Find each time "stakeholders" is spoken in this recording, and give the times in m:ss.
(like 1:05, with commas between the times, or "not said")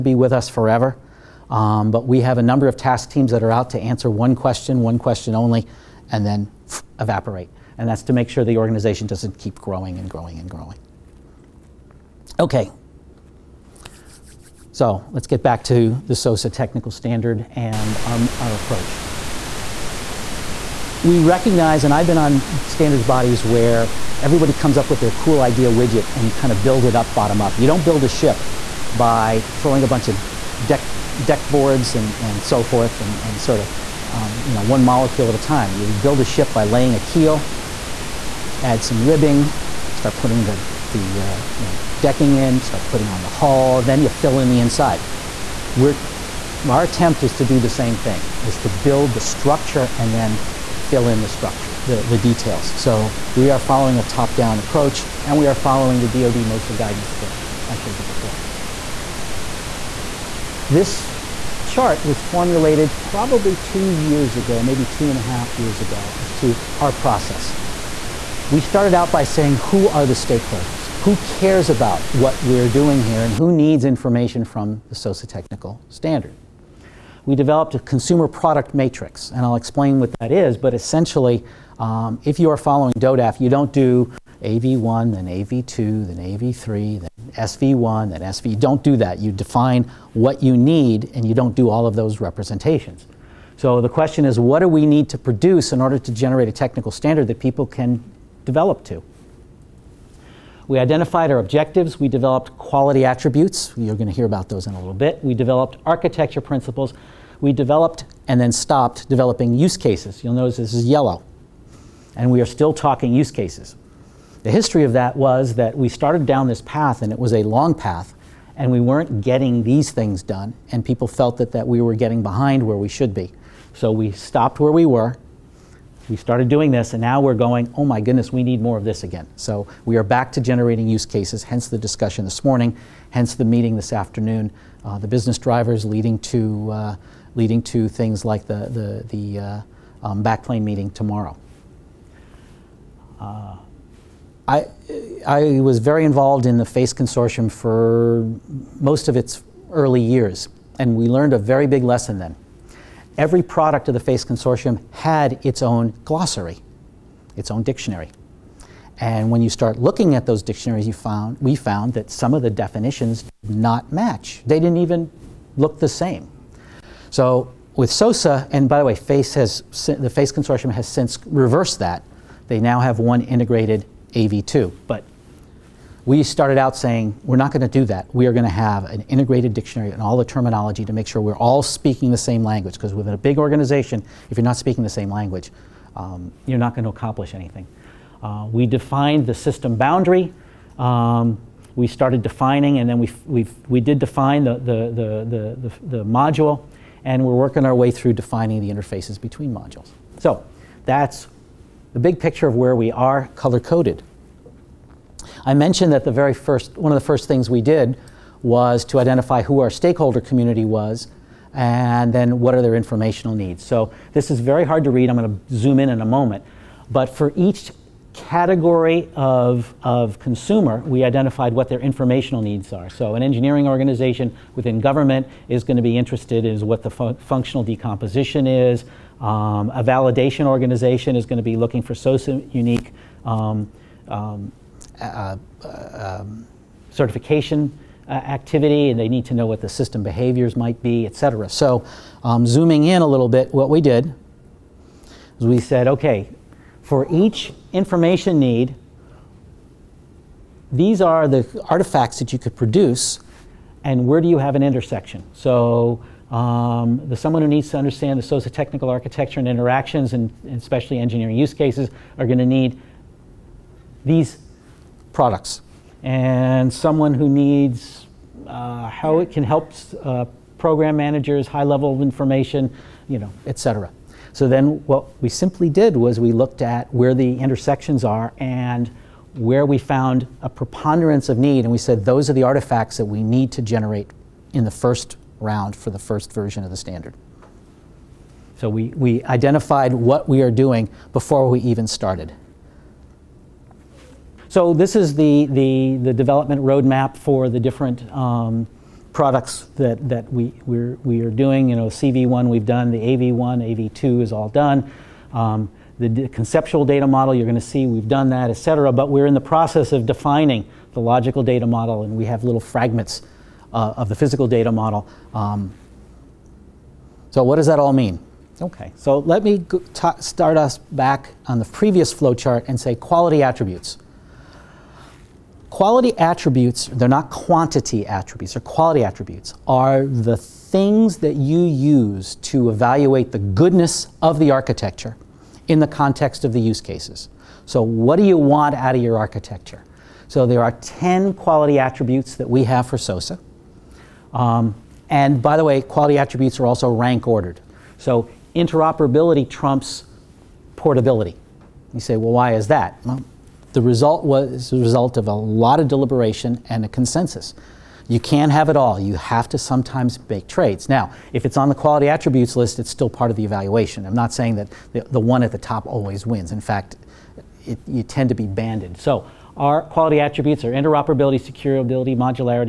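1:10, 3:29.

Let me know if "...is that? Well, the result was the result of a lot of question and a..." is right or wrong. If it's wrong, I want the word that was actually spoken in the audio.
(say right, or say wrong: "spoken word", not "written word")
wrong: "deliberation", not "question".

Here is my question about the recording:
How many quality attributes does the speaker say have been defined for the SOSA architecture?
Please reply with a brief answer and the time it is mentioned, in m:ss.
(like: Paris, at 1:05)
10, at 5:40.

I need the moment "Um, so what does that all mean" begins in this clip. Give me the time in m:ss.
5:15.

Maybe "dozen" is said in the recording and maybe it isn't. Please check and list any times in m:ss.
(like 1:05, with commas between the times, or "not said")
not said.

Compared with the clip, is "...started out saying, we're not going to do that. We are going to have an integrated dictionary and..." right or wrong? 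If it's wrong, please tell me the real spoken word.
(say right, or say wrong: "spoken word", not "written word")
right.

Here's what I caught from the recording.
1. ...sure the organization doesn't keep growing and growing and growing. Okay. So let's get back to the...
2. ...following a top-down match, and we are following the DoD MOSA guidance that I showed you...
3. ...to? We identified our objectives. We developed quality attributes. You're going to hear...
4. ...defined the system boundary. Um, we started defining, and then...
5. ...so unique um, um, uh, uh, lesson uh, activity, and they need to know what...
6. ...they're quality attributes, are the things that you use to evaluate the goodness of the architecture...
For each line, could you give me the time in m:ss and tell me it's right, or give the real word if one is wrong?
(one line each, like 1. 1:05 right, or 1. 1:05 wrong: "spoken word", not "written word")
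1. 0:08 right
2. 0:53 wrong: "approach", not "match"
3. 1:38 right
4. 3:08 right
5. 3:51 wrong: "certification", not "lesson"
6. 5:28 right.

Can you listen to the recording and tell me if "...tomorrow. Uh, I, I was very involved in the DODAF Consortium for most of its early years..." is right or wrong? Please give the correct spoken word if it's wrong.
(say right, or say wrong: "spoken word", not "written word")
wrong: "FACE", not "DODAF".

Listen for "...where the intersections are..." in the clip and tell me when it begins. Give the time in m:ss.
4:36.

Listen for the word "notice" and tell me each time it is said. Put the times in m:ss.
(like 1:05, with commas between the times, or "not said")
1:50.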